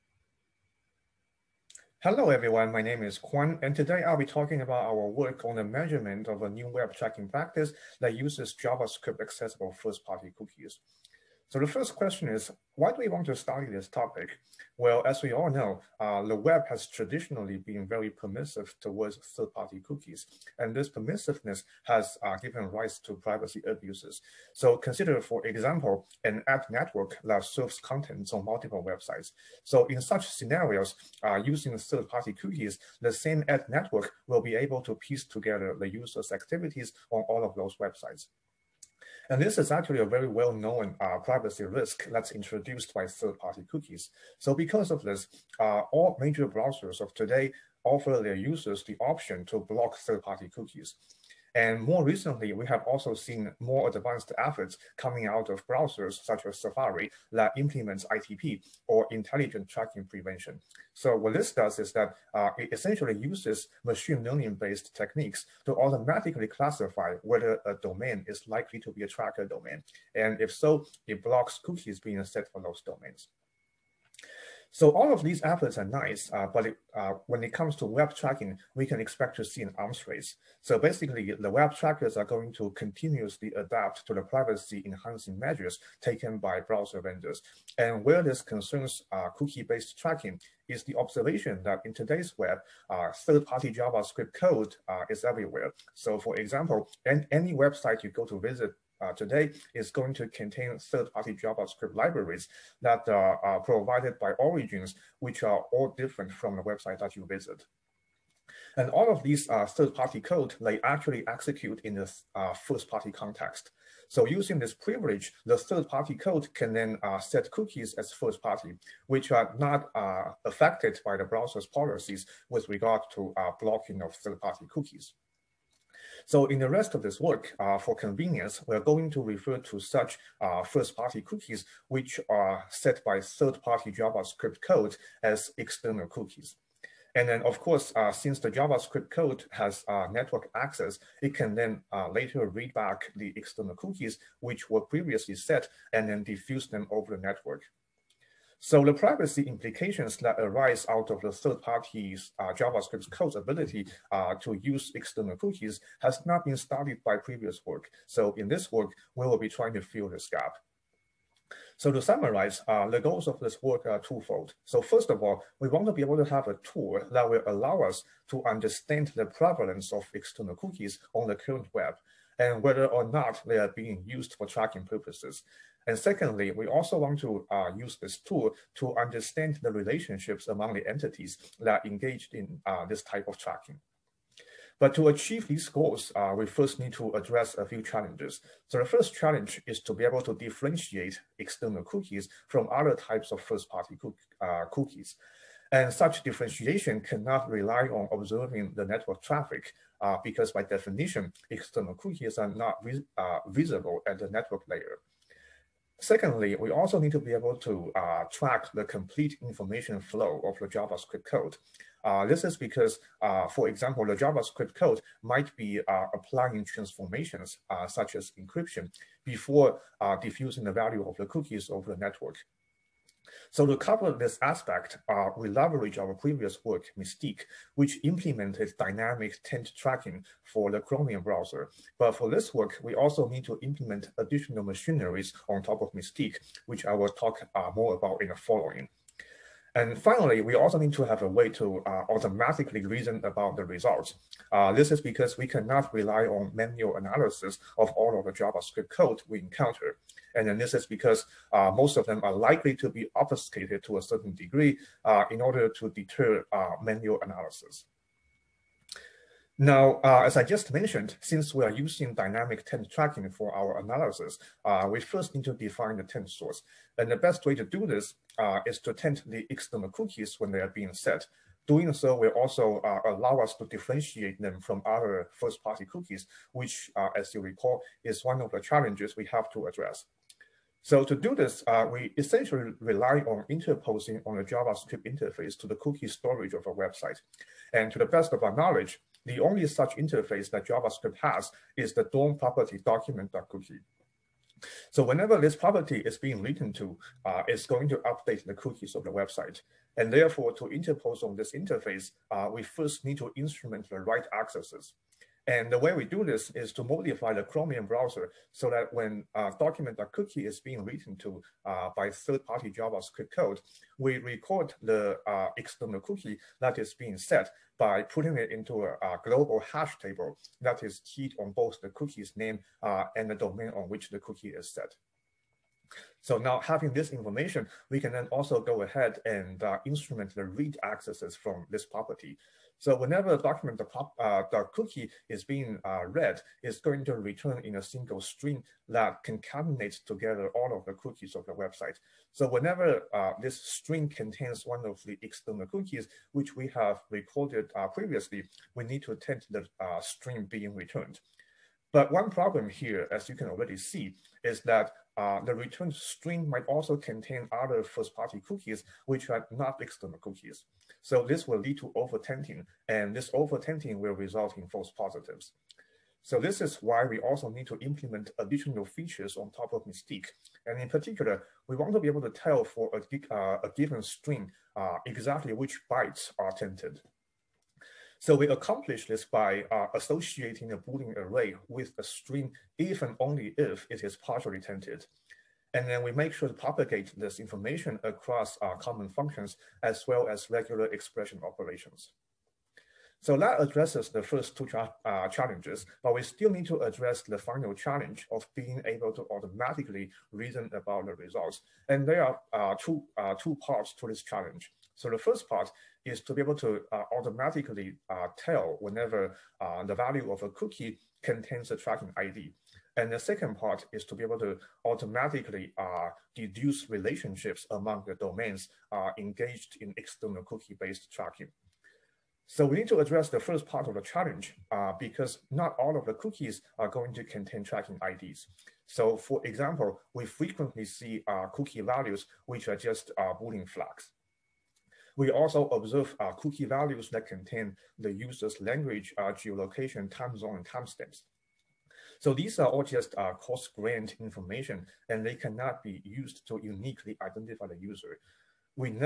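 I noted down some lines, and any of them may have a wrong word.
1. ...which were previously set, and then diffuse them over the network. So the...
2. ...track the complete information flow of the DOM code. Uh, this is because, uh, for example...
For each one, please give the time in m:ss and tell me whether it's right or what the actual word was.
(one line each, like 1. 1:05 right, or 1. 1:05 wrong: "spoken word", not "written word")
1. 2:24 right
2. 3:28 wrong: "JavaScript", not "DOM".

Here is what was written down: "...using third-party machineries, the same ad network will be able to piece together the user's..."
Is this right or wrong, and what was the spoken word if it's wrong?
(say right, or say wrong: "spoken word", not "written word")
wrong: "cookies", not "machineries".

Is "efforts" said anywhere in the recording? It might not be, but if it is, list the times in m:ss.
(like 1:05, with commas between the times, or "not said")
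0:54, 1:15.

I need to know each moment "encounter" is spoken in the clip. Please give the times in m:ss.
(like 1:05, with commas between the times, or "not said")
4:09.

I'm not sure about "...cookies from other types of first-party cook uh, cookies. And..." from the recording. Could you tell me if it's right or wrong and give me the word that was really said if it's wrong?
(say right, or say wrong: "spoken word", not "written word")
right.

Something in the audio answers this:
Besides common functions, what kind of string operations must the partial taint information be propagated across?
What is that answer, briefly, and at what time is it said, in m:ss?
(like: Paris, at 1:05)
regular expression operations, at 6:30.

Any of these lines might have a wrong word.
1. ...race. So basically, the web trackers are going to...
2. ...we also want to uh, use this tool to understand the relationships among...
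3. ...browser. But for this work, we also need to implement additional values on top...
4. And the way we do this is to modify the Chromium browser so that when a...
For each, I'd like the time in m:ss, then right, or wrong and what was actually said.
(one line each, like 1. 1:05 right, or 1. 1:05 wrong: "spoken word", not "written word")
1. 1:20 right
2. 2:56 right
3. 3:51 wrong: "machineries", not "values"
4. 5:05 right.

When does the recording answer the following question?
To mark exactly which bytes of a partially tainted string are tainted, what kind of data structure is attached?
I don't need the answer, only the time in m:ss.
6:20.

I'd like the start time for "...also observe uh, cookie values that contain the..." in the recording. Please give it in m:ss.
7:15.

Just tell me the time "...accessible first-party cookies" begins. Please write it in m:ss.
0:09.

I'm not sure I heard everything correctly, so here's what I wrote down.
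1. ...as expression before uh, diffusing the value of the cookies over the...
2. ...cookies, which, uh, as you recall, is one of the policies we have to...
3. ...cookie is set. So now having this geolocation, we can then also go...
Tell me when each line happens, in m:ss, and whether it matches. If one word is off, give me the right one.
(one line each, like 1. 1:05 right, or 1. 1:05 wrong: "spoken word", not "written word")
1. 3:38 wrong: "encryption", not "expression"
2. 4:35 wrong: "challenges", not "policies"
3. 5:24 wrong: "information", not "geolocation".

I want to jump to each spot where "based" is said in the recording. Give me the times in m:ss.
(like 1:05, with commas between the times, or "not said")
1:04, 1:29, 7:00.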